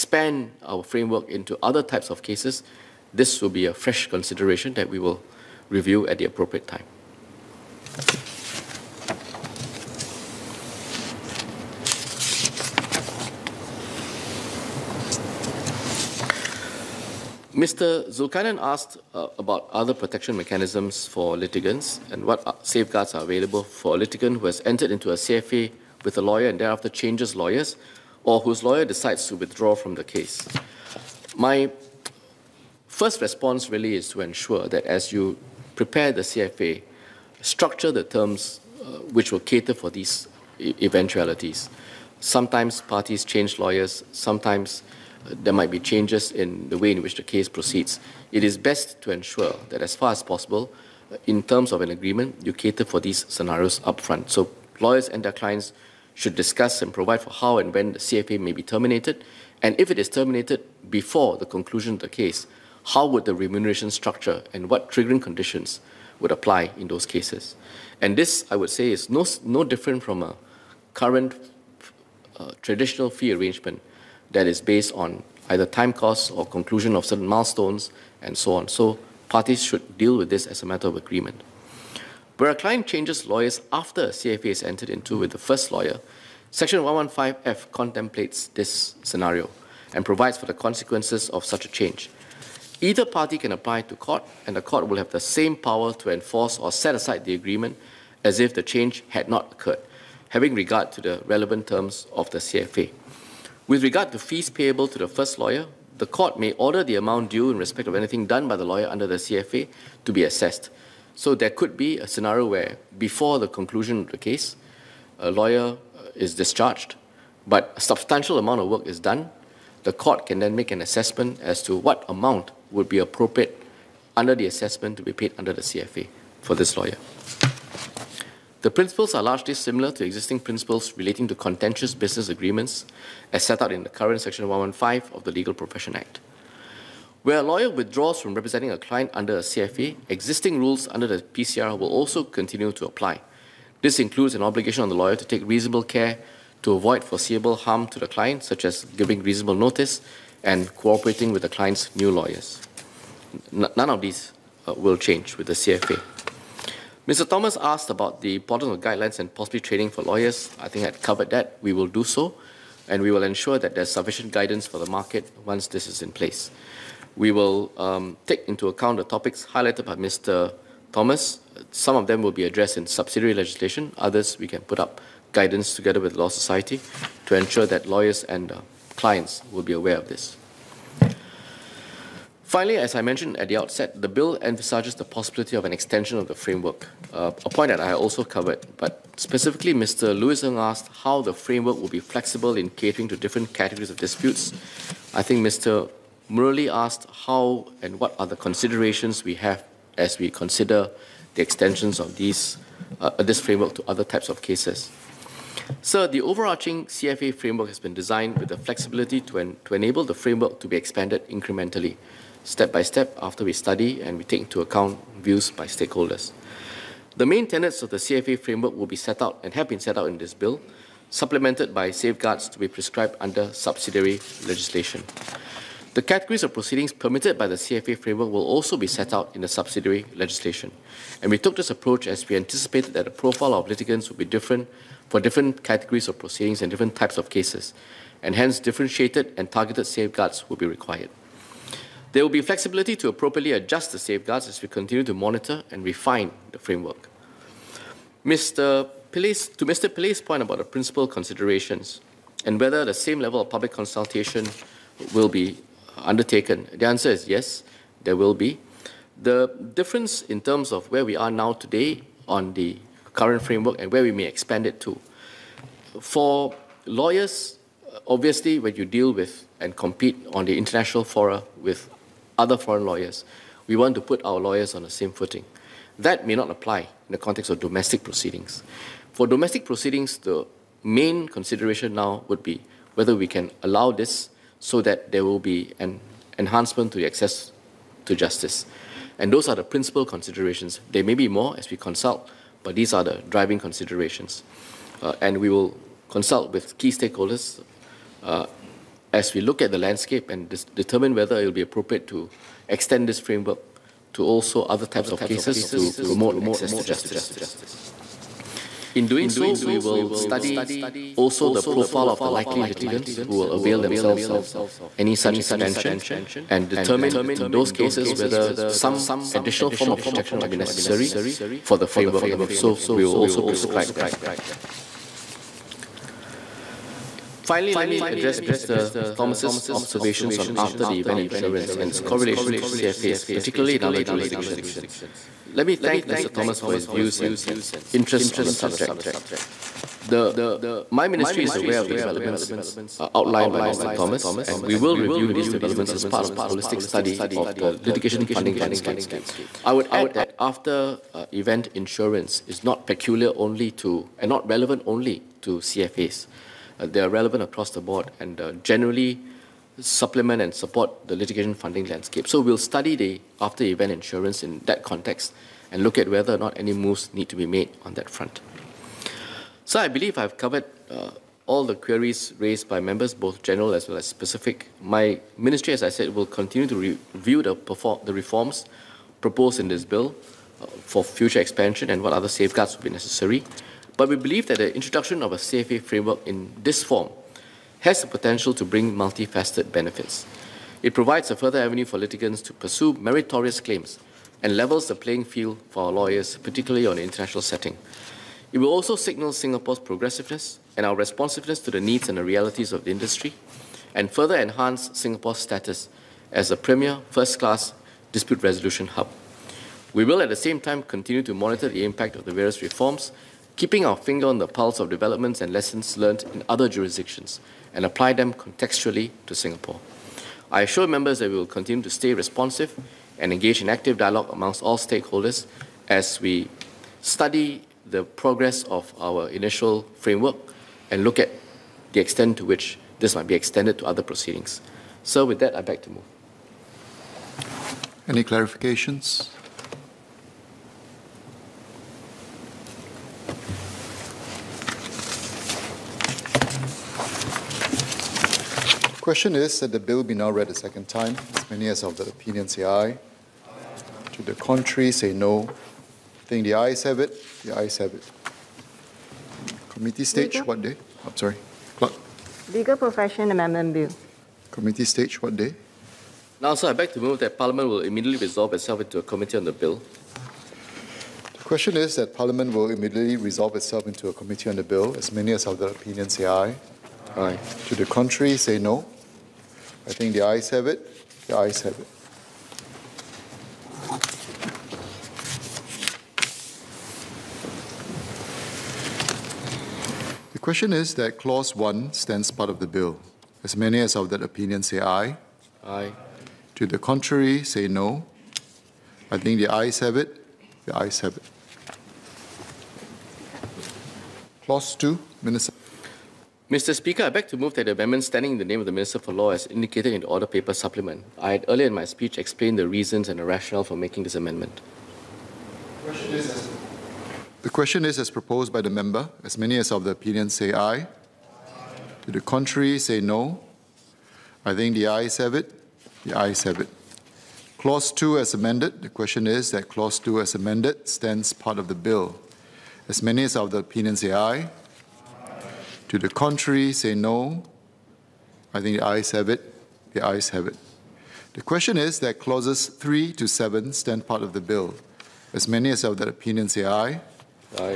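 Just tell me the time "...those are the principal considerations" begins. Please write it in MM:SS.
04:49.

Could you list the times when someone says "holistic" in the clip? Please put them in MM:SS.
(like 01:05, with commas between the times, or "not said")
05:46.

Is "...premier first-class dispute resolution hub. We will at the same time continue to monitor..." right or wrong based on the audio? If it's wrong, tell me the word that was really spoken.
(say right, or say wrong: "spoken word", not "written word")
right.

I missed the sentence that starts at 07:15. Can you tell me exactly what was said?
So with that, I beg to move.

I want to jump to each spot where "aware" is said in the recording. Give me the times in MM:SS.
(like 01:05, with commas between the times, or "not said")
02:59, 05:41.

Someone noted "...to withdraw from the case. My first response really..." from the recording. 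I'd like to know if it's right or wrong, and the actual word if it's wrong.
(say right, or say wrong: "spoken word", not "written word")
right.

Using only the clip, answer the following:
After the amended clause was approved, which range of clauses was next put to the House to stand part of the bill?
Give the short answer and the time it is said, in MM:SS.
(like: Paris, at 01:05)
clauses 3 to 7, at 09:02.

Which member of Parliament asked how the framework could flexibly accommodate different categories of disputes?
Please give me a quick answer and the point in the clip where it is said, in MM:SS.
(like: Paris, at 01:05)
Louis Ng, at 03:09.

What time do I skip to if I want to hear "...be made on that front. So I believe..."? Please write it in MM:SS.
06:07.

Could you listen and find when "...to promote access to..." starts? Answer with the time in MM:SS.
05:05.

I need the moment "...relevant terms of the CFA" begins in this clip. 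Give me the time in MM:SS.
01:41.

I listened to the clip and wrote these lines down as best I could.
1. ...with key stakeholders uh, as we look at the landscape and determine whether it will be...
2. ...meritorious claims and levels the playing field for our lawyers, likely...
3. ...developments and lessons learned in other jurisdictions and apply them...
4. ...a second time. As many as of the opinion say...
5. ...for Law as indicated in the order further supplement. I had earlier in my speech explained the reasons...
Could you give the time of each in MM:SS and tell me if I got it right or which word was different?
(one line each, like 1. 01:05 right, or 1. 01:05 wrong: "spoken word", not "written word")
1. 04:56 right
2. 06:32 wrong: "particularly", not "likely"
3. 06:54 right
4. 07:30 right
5. 08:28 wrong: "paper", not "further".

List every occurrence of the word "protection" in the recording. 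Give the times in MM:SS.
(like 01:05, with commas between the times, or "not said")
00:19, 05:20.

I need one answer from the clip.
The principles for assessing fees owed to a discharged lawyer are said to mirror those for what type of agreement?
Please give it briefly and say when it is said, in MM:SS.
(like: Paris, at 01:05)
contentious business agreements, at 02:11.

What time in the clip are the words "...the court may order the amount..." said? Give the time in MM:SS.
01:45.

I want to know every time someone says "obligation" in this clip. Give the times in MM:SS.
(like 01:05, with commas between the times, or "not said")
02:24.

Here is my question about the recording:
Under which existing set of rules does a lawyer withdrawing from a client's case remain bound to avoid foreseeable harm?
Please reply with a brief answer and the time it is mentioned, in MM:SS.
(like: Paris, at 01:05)
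PCR, at 02:21.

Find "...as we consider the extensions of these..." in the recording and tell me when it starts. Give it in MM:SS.
03:19.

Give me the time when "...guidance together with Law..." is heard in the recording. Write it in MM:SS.
02:55.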